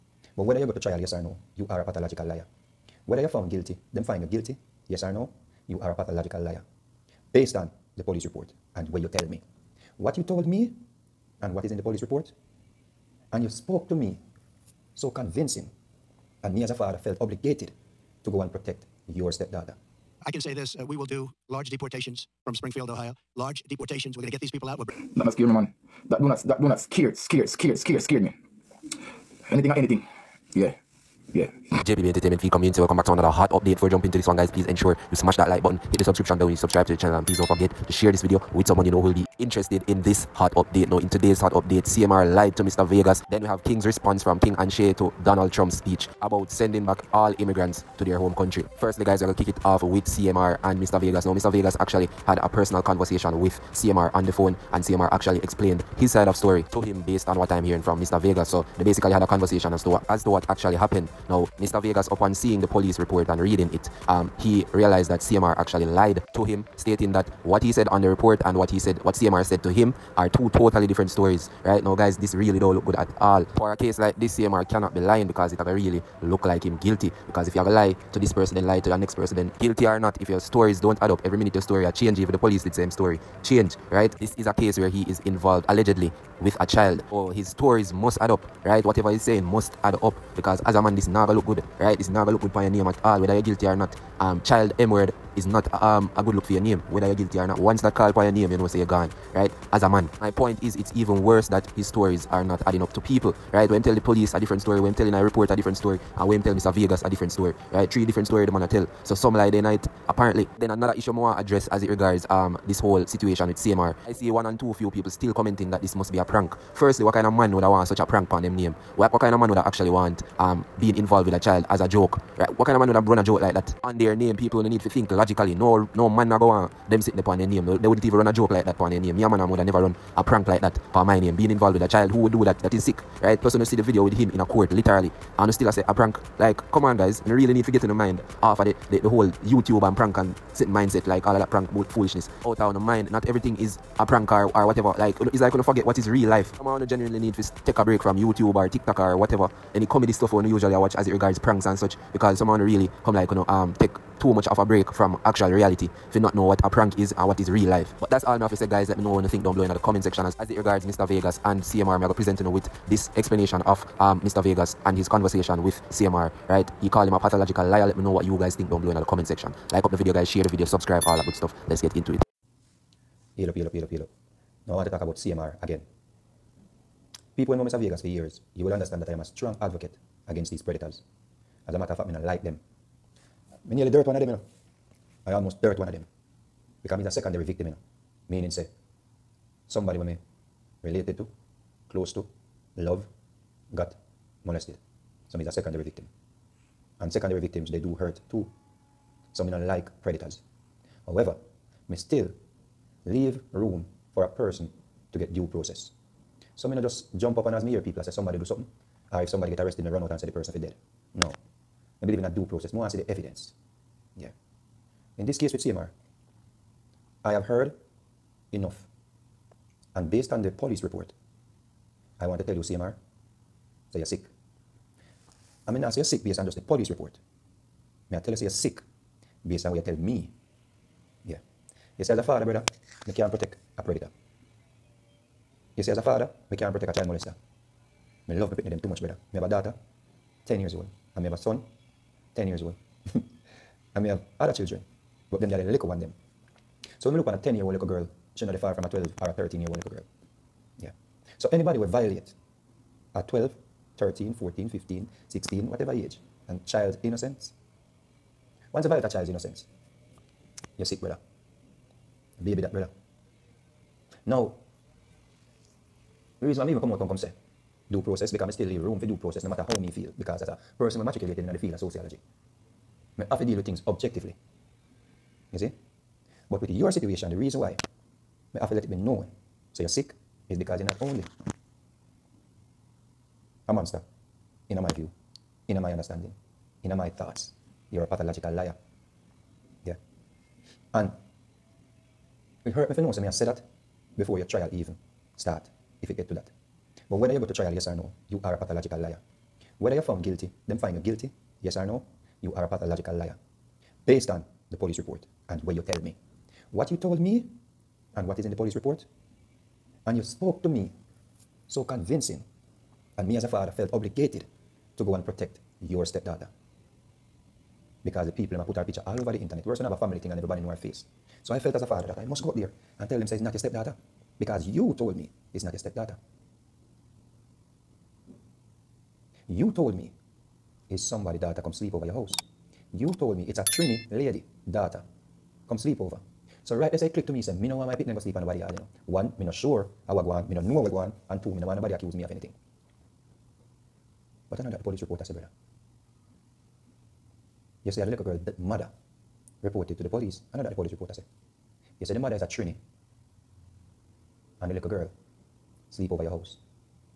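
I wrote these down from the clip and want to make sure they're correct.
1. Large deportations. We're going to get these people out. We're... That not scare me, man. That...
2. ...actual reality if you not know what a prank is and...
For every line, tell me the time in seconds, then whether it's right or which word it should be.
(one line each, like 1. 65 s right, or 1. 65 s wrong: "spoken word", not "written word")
1. 23 s right
2. 155 s right.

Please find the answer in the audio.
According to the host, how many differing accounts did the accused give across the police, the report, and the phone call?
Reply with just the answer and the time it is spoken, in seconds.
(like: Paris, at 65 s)
3, at 107 s.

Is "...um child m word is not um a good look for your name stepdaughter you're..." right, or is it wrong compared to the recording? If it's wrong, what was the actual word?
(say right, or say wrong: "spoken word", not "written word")
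wrong: "whether", not "stepdaughter".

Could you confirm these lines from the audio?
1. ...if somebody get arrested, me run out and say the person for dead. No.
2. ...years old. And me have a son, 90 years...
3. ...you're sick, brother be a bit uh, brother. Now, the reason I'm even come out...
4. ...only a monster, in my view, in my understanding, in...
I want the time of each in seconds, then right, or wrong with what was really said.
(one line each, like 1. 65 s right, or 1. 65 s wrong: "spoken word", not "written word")
1. 209 s right
2. 240 s wrong: "10", not "90"
3. 260 s right
4. 281 s right.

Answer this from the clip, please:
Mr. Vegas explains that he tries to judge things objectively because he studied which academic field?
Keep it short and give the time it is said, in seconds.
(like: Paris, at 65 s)
Sociology, at 271 s.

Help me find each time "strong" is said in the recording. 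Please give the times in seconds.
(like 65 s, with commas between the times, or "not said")
179 s.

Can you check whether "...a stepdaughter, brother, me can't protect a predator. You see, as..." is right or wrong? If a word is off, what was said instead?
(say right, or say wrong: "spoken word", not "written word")
wrong: "father", not "stepdaughter".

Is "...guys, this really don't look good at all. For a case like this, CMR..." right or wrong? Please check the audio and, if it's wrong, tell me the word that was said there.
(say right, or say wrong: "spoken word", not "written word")
right.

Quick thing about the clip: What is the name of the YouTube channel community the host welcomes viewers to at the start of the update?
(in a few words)
JPB Entertainment.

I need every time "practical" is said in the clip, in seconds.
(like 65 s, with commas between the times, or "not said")
not said.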